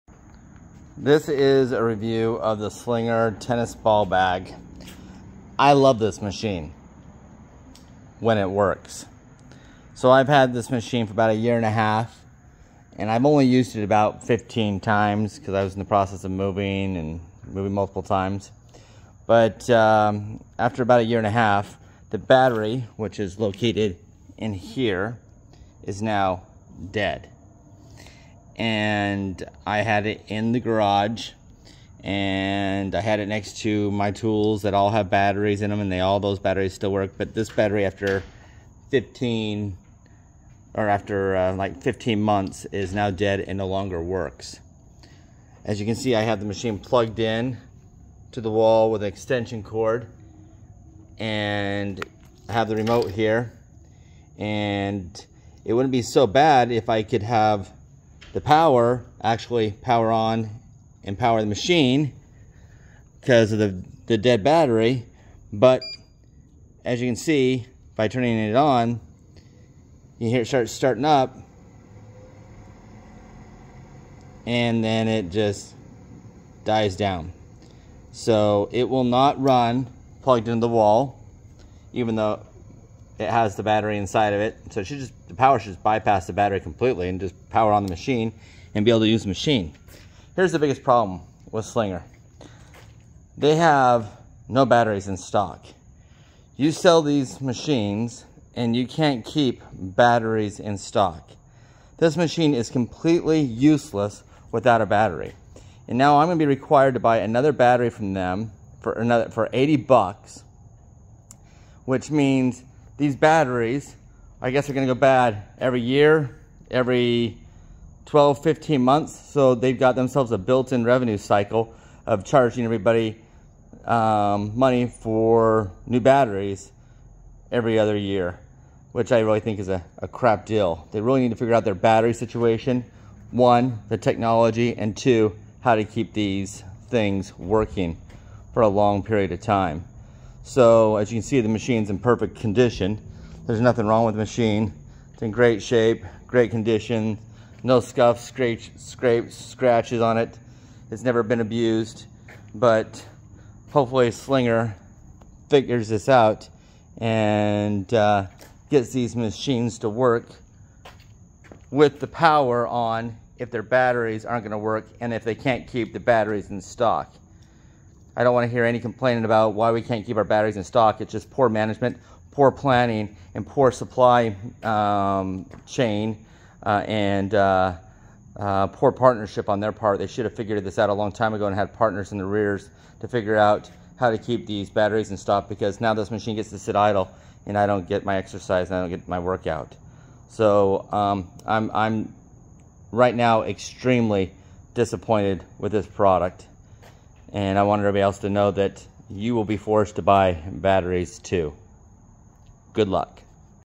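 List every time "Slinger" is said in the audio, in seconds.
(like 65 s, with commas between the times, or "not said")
2 s, 91 s, 154 s.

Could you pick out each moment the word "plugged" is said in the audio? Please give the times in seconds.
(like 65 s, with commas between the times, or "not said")
46 s, 80 s.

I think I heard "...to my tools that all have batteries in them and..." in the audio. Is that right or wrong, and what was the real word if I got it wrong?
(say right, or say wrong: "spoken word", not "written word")
right.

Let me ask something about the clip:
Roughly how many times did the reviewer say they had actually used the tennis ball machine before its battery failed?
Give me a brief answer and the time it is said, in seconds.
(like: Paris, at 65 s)
15, at 14 s.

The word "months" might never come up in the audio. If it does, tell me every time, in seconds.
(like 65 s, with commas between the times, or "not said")
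42 s, 118 s.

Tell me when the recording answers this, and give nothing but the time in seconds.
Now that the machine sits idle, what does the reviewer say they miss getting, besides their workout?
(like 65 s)
188 s.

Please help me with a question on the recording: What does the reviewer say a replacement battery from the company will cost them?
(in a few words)
80 bucks.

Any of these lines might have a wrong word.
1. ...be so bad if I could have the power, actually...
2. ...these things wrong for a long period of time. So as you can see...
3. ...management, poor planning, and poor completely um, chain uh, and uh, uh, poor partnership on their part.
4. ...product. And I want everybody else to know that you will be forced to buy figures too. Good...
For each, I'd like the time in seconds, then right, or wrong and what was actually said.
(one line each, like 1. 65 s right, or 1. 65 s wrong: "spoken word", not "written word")
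1. 55 s right
2. 136 s wrong: "working", not "wrong"
3. 171 s wrong: "supply", not "completely"
4. 195 s wrong: "batteries", not "figures".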